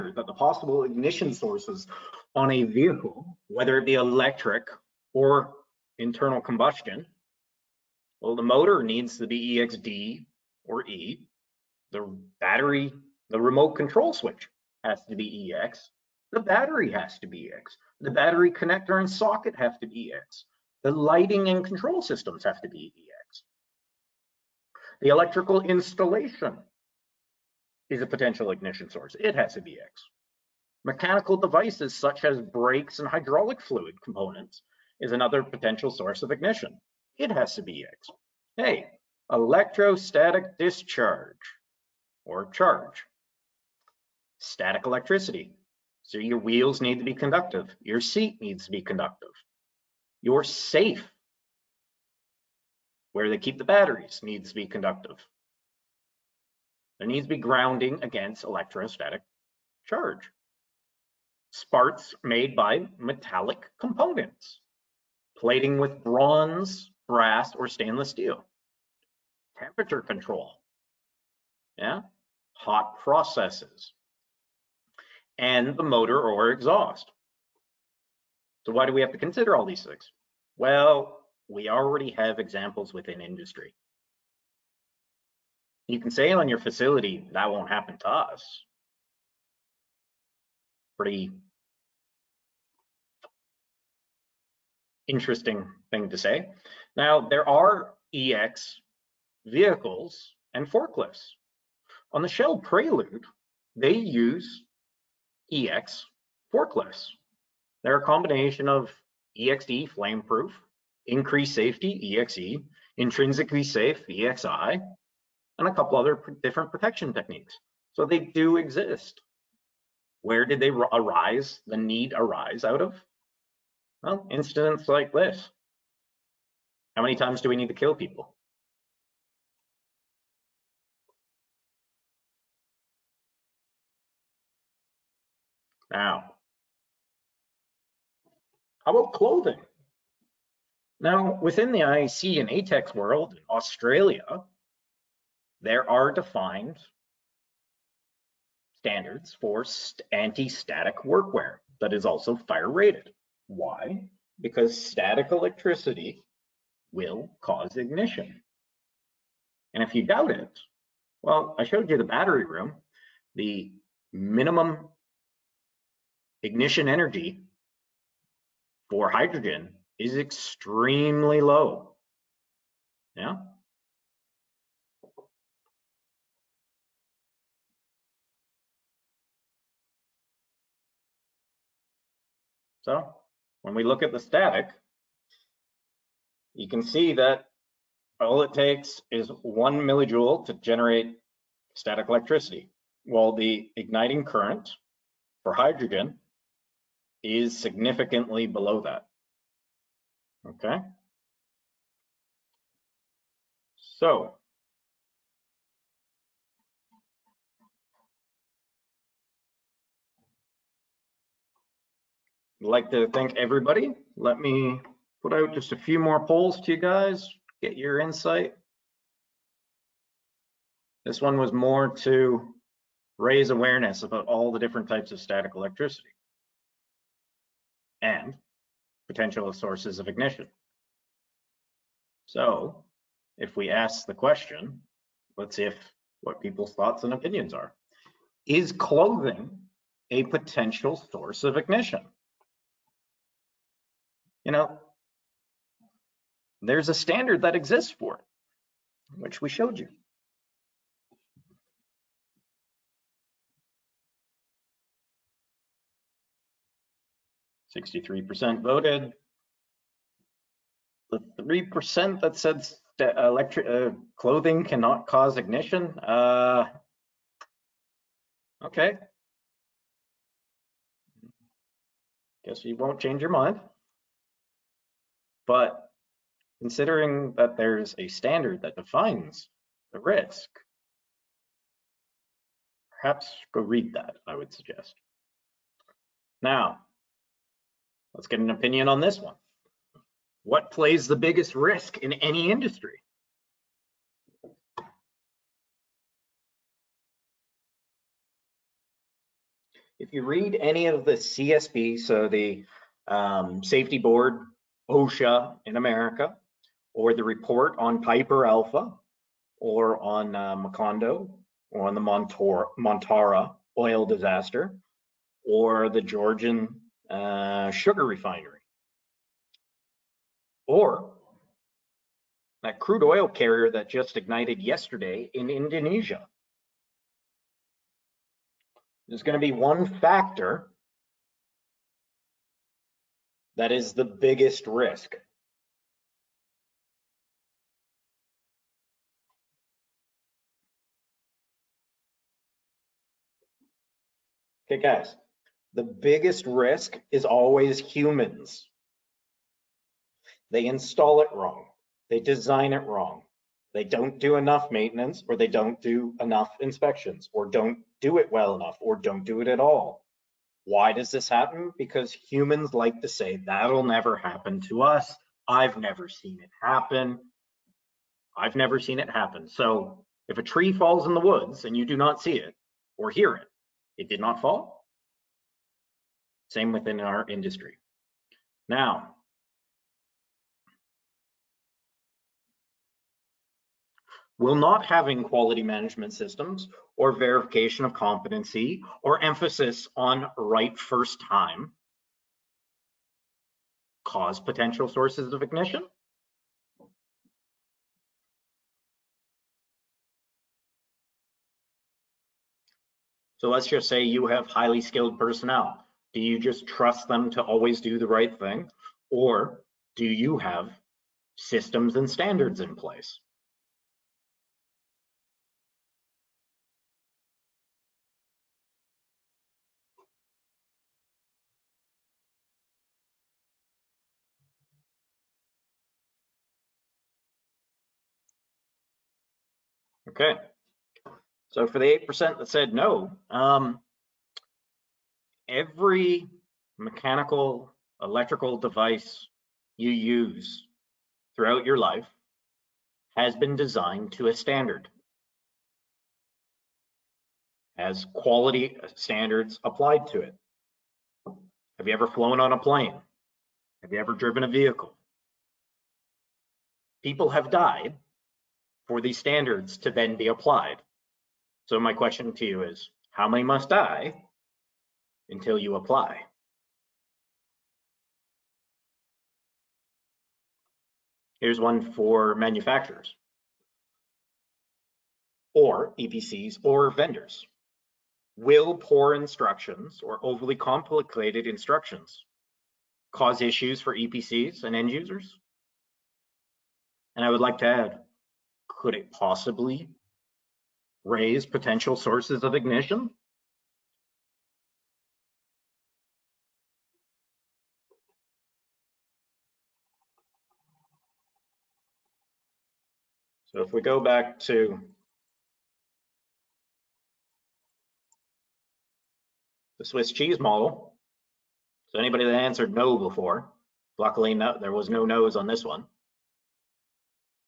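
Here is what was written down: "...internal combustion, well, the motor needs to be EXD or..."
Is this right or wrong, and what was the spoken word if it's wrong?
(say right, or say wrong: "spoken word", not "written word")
right.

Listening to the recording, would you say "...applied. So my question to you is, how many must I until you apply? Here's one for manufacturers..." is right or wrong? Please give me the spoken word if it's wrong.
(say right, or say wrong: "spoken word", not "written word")
right.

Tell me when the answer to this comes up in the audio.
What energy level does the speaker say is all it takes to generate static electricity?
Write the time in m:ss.
3:09.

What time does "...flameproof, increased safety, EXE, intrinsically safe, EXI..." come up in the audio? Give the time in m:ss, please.
1:49.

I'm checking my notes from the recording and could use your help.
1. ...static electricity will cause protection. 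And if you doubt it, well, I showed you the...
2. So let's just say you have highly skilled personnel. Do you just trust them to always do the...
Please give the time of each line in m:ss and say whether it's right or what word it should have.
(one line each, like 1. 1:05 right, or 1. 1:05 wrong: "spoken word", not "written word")
1. 2:34 wrong: "ignition", not "protection"
2. 6:43 right.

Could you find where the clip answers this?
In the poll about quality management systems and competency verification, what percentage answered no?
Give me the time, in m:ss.
7:12.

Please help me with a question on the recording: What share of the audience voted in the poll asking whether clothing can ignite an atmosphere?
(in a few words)
63%.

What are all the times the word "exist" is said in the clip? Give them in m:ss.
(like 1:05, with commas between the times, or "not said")
1:58, 4:07.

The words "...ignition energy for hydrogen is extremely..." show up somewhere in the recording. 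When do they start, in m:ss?
2:46.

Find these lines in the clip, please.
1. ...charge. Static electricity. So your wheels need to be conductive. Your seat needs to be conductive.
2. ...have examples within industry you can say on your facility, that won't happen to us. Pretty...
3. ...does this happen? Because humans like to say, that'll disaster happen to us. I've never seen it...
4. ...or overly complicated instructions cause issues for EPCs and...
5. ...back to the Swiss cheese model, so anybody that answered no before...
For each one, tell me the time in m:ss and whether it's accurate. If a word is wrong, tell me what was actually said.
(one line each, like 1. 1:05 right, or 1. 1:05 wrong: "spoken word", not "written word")
1. 0:42 right
2. 1:22 right
3. 6:00 wrong: "never", not "disaster"
4. 8:00 right
5. 8:23 right.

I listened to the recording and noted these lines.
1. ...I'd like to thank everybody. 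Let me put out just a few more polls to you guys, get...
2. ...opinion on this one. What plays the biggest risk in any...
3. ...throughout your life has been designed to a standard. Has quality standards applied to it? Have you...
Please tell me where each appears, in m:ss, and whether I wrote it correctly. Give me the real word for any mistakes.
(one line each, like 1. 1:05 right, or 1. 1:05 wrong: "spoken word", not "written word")
1. 3:32 right
2. 4:48 right
3. 7:21 right.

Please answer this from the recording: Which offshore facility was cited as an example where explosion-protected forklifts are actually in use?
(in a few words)
Shell Prelude.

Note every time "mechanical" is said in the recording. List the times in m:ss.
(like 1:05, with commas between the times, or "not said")
0:30, 7:16.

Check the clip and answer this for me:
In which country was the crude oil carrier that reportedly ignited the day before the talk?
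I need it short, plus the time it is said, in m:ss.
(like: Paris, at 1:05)
Indonesia, at 5:25.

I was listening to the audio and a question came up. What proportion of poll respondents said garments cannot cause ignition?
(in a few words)
3%.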